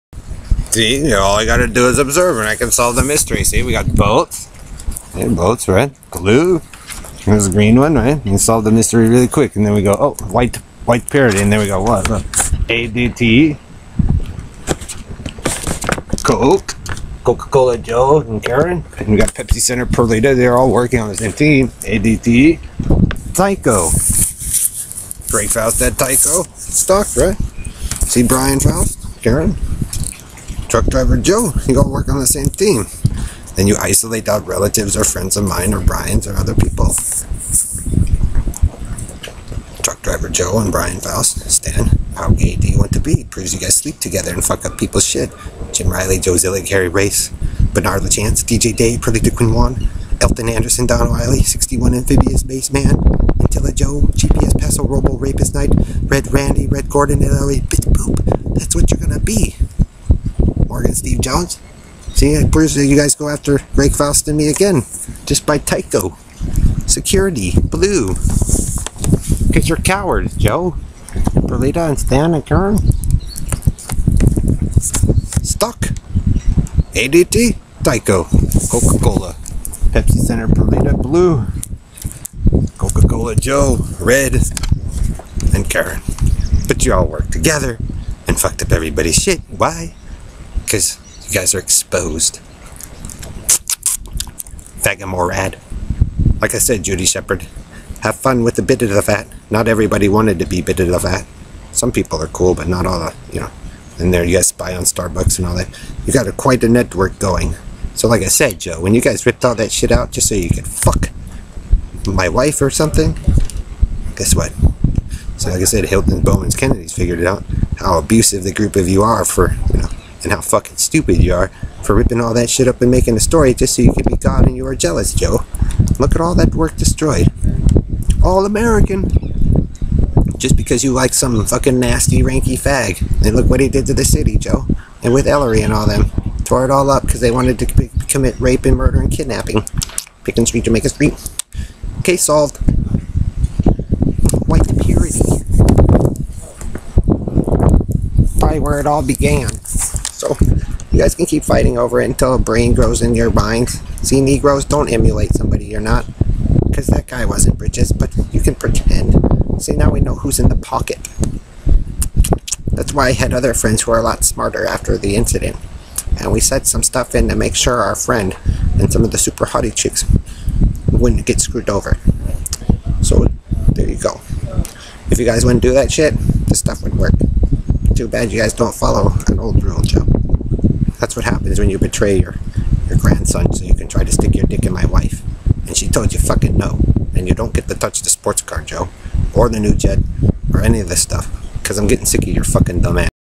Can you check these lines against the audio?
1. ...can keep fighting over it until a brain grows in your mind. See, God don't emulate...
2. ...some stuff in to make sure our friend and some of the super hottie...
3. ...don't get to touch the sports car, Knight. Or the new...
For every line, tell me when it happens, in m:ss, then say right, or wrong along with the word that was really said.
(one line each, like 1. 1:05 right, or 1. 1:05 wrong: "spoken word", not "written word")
1. 2:31 wrong: "Negroes", not "God"
2. 2:46 right
3. 3:07 wrong: "Joe", not "Knight".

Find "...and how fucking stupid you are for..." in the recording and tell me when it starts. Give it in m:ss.
2:00.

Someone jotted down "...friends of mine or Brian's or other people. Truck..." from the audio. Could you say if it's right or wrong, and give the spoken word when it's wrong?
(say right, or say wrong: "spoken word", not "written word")
right.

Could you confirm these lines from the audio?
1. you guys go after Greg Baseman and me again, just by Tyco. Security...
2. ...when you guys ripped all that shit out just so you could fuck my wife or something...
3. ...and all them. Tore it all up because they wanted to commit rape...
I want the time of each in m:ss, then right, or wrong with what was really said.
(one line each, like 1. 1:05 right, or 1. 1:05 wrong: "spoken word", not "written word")
1. 1:02 wrong: "Faust", not "Baseman"
2. 1:48 right
3. 2:15 right.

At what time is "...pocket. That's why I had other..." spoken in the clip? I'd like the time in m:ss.
2:40.